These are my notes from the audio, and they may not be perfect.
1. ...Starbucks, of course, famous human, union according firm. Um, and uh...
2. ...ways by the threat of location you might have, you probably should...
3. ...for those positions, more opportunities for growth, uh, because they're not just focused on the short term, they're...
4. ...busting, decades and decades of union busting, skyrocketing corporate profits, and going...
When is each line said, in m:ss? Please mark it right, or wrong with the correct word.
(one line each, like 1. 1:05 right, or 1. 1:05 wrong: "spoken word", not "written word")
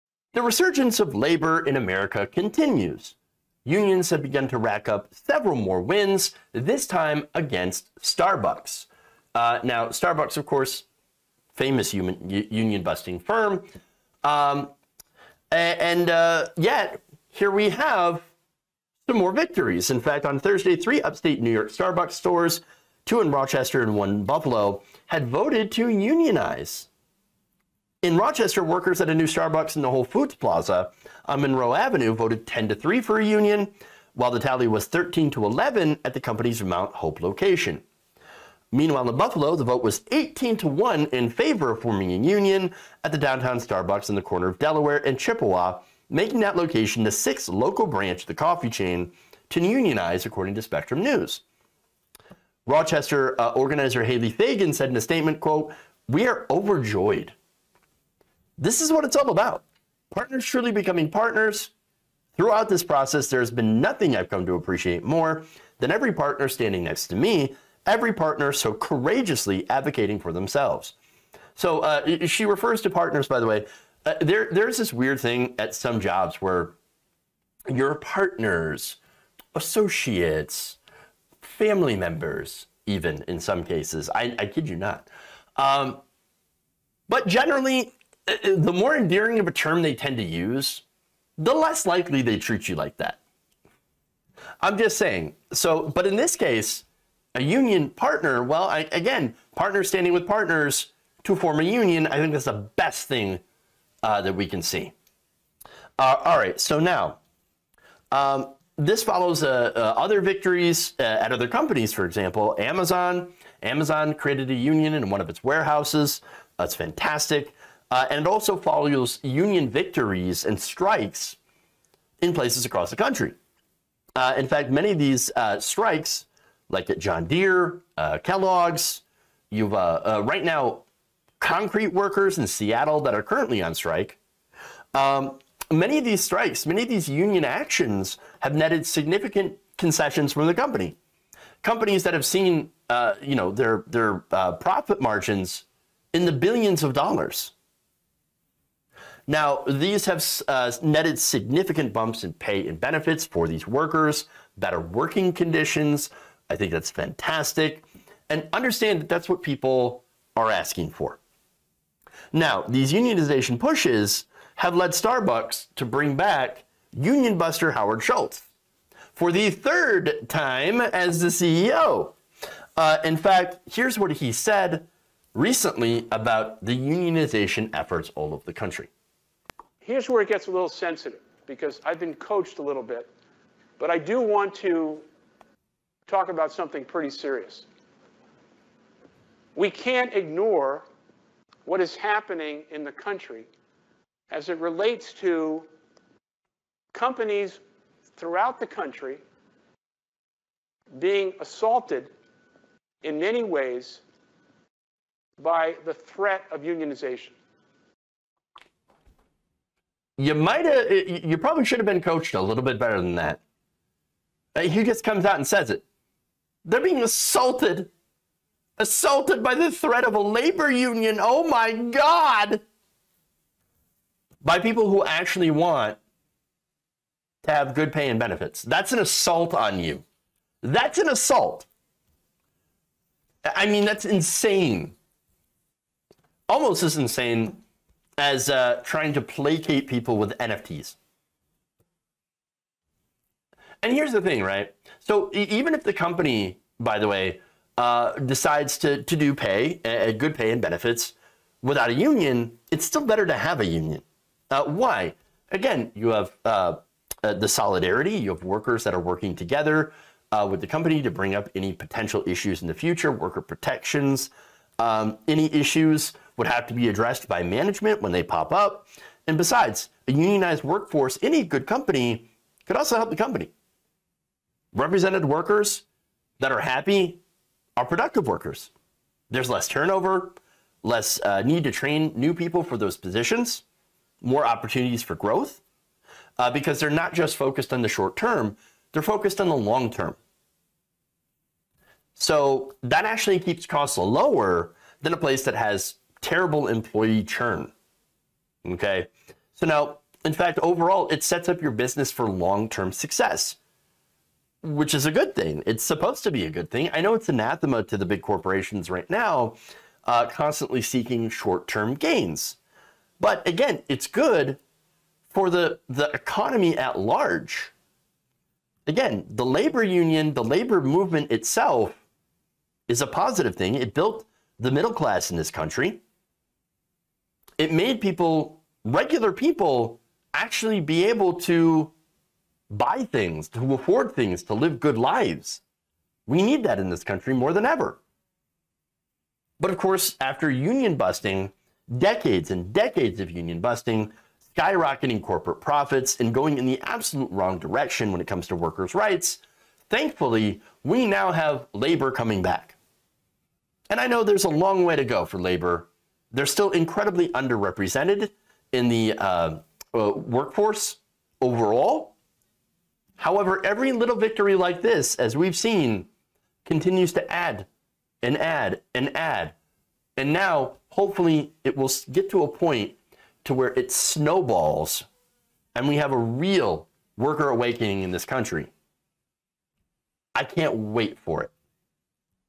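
1. 0:09 wrong: "busting", not "according"
2. 3:23 wrong: "unionization", not "location"
3. 4:42 right
4. 5:40 right.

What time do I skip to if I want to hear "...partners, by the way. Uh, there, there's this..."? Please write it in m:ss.
1:12.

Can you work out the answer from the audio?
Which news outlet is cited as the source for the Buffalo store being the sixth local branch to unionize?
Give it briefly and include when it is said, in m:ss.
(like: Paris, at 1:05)
Spectrum News, at 0:50.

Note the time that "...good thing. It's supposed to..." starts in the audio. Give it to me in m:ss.
5:05.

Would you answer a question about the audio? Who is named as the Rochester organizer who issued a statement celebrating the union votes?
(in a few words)
Haley Fagan.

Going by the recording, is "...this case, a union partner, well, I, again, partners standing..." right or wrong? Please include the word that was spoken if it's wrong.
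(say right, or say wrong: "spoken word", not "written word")
right.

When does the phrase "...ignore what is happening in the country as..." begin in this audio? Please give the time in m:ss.
3:10.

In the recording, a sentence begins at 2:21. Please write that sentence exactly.
Companies that have seen, you know, their their profit margins in the billions of dollars.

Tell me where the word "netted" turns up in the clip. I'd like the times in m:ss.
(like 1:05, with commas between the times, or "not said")
2:18, 2:30.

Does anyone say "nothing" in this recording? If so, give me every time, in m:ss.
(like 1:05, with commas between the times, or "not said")
1:03.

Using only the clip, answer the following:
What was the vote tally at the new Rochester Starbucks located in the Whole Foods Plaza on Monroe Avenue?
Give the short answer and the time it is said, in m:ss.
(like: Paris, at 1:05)
10 to 3, at 0:32.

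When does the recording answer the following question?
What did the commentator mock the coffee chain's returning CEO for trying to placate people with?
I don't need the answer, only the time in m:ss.
4:00.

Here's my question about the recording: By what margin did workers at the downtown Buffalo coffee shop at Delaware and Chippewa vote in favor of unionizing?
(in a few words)
18 to 1.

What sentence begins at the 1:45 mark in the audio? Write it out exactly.
Uh, all right, so now, um, this follows uh, uh other victories uh, at other companies, for example, Amazon.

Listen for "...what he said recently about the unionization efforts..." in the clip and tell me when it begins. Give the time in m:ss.
2:53.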